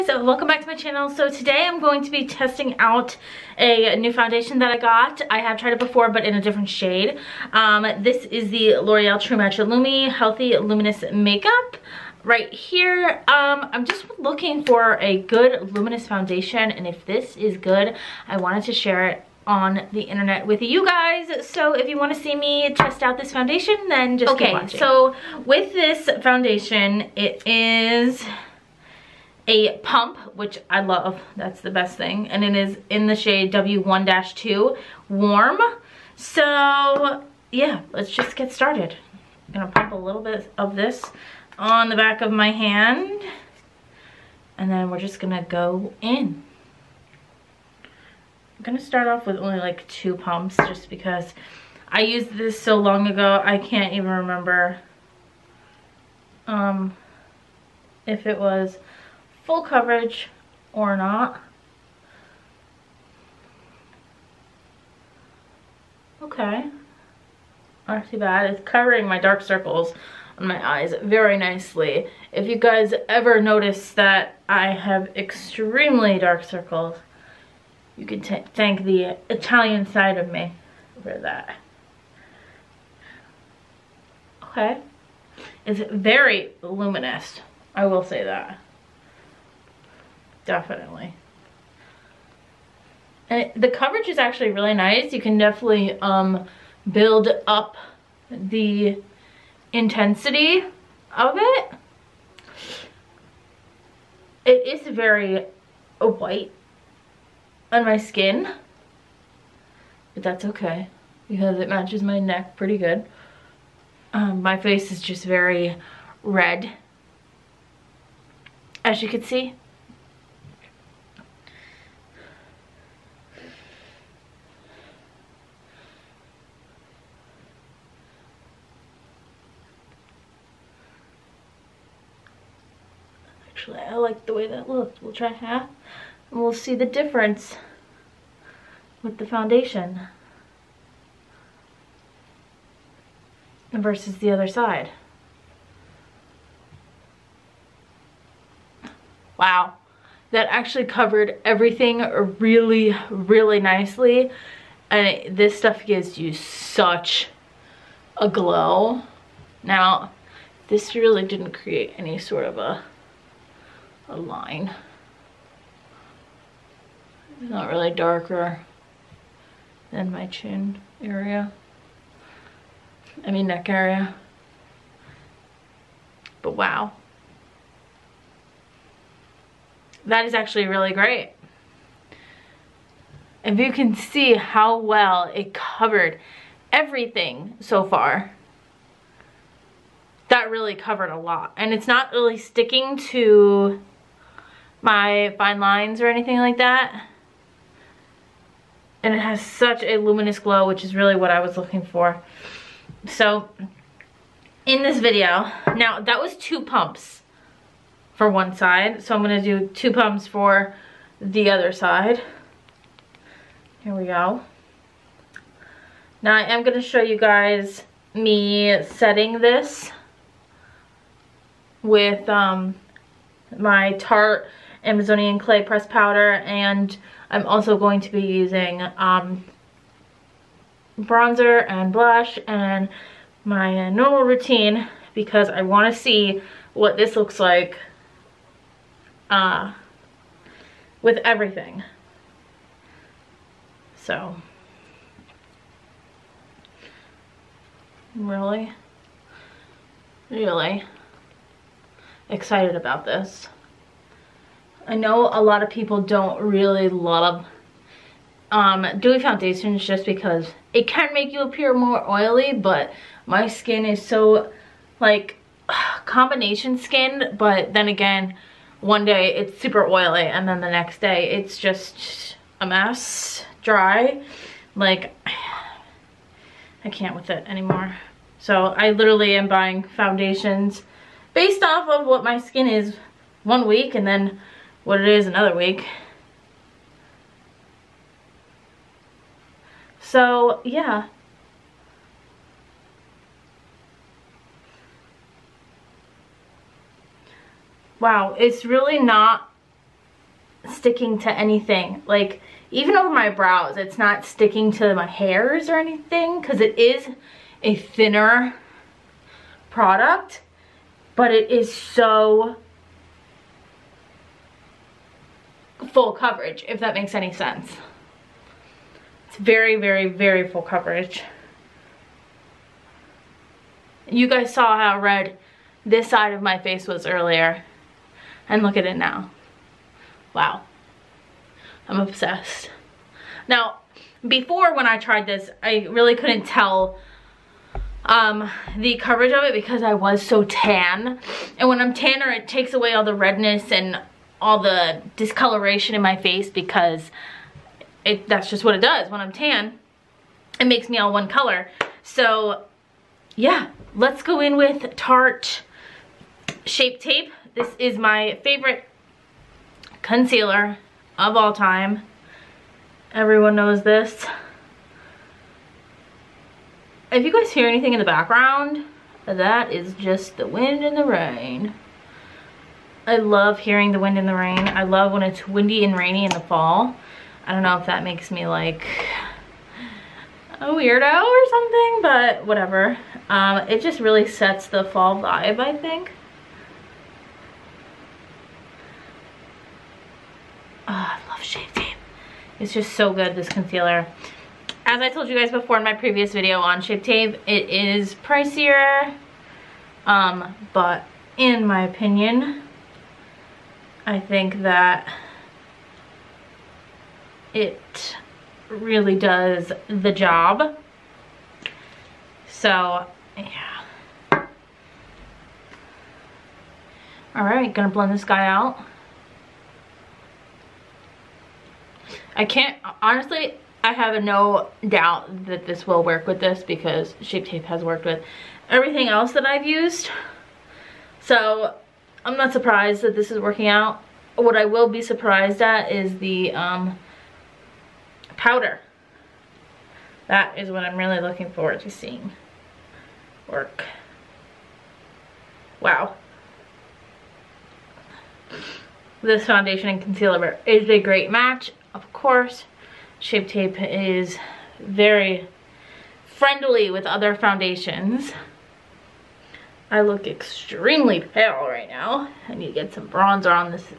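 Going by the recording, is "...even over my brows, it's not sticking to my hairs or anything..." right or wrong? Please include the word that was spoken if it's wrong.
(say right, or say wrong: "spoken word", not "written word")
right.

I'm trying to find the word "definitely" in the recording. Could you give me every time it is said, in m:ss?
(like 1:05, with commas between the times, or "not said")
1:30, 1:35.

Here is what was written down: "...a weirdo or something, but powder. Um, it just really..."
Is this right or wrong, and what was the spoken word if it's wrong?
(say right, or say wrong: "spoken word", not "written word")
wrong: "whatever", not "powder".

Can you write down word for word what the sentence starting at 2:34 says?
And this stuff gives you such a glow.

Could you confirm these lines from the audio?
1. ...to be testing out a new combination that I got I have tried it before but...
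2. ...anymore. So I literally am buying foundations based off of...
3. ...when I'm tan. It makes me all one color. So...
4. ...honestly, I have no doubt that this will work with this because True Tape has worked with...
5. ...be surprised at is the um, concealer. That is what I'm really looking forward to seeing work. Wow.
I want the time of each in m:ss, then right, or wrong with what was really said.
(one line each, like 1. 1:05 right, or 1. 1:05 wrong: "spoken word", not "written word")
1. 0:02 wrong: "foundation", not "combination"
2. 4:37 right
3. 5:49 right
4. 7:03 wrong: "Shape", not "True"
5. 7:14 wrong: "powder", not "concealer".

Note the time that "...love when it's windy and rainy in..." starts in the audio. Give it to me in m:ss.
6:14.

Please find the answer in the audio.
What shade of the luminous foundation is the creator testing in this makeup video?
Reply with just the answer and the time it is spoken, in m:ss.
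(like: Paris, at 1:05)
W1-2 Warm, at 0:33.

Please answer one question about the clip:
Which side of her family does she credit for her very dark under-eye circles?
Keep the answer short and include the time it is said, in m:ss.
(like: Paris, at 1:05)
Italian, at 1:19.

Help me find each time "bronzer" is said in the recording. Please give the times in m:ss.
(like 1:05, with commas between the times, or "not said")
3:50, 7:43.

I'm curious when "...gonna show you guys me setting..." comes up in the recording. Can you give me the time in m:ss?
3:36.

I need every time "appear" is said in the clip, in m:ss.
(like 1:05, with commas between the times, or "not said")
4:21.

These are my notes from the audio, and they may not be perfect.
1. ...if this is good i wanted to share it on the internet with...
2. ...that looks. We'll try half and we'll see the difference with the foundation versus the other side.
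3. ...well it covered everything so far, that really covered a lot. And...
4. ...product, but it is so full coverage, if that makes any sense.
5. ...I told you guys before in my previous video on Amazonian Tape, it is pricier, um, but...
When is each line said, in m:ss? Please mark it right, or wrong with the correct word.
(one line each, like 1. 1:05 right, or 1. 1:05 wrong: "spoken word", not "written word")
1. 0:16 right
2. 2:14 right
3. 3:04 right
4. 5:09 right
5. 6:35 wrong: "Shape", not "Amazonian".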